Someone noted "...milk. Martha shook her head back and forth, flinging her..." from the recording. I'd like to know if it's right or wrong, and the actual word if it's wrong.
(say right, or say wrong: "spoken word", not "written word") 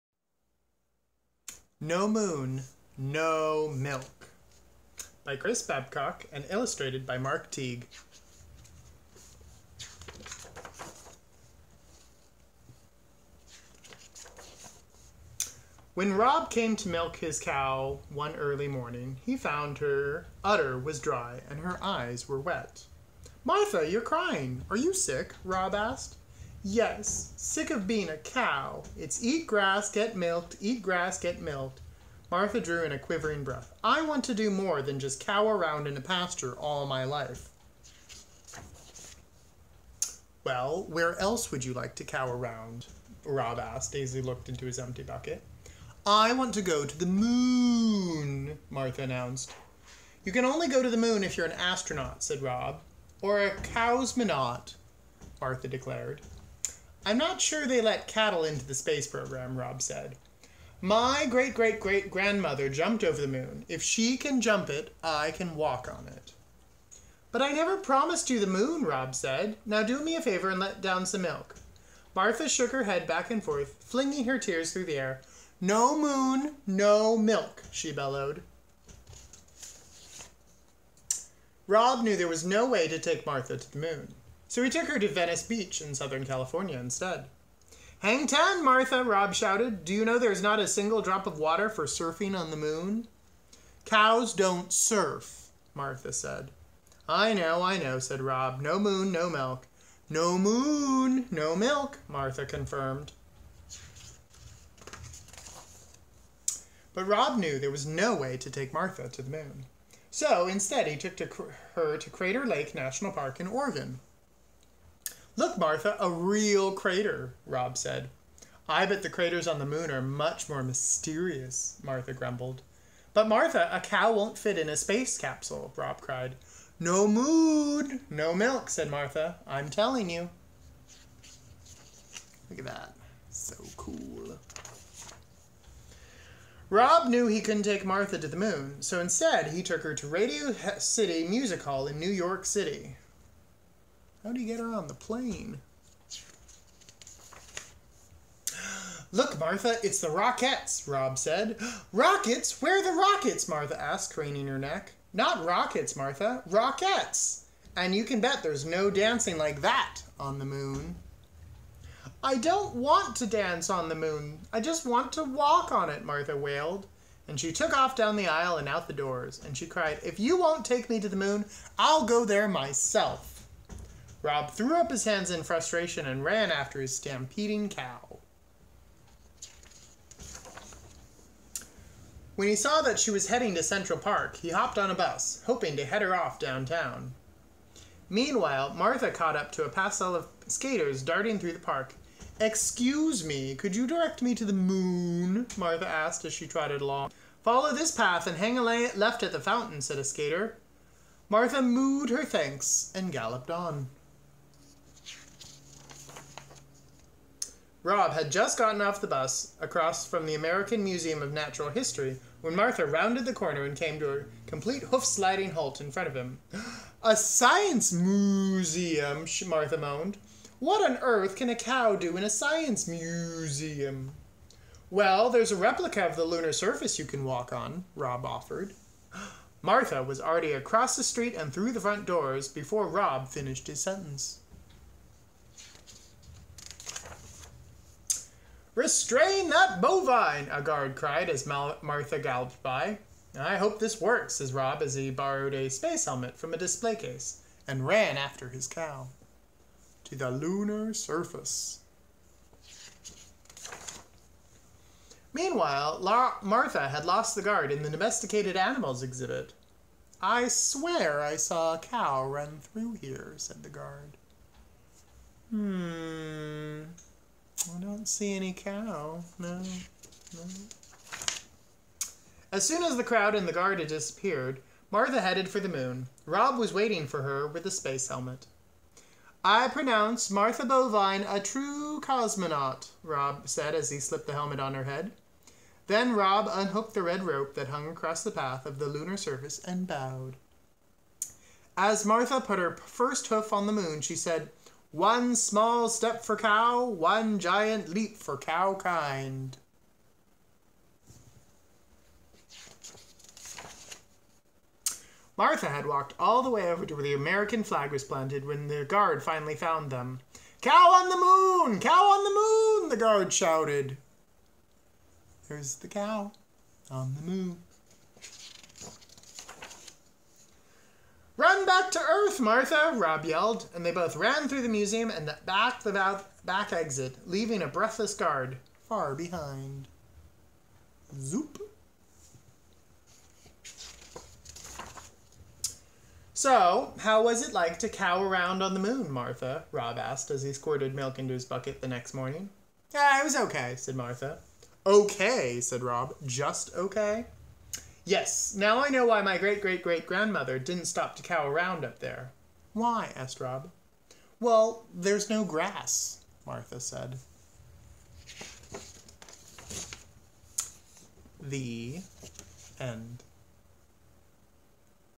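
right.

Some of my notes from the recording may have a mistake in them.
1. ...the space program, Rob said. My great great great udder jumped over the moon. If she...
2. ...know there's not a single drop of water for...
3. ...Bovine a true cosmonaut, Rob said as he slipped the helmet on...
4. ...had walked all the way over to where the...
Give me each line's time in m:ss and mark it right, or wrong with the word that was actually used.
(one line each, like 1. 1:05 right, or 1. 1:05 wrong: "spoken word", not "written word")
1. 0:58 wrong: "grandmother", not "udder"
2. 1:30 right
3. 4:40 right
4. 5:05 right.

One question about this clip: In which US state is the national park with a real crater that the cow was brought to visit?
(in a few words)
Oregon.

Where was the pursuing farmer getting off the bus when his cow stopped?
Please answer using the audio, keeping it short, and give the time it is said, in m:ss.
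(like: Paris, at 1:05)
American Museum of Natural History, at 3:30.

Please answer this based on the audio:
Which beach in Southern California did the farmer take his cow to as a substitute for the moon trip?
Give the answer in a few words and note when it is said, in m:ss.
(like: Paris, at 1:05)
Venice Beach, at 1:25.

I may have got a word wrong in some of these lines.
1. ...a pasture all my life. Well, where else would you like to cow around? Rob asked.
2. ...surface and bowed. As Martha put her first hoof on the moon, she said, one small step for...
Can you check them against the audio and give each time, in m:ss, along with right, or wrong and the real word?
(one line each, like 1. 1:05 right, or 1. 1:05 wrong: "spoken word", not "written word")
1. 0:35 right
2. 4:49 right.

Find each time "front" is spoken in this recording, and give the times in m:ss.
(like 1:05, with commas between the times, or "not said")
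3:35, 3:51.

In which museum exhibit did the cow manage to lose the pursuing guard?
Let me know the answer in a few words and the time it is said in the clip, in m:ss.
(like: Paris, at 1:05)
domesticated animals exhibit, at 4:17.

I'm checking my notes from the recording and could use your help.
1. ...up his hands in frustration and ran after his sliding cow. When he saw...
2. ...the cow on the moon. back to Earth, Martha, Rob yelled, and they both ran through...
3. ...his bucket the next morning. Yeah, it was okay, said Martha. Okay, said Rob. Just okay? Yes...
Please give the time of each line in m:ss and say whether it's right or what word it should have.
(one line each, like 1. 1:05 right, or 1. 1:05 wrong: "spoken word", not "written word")
1. 2:54 wrong: "stampeding", not "sliding"
2. 5:15 right
3. 5:41 right.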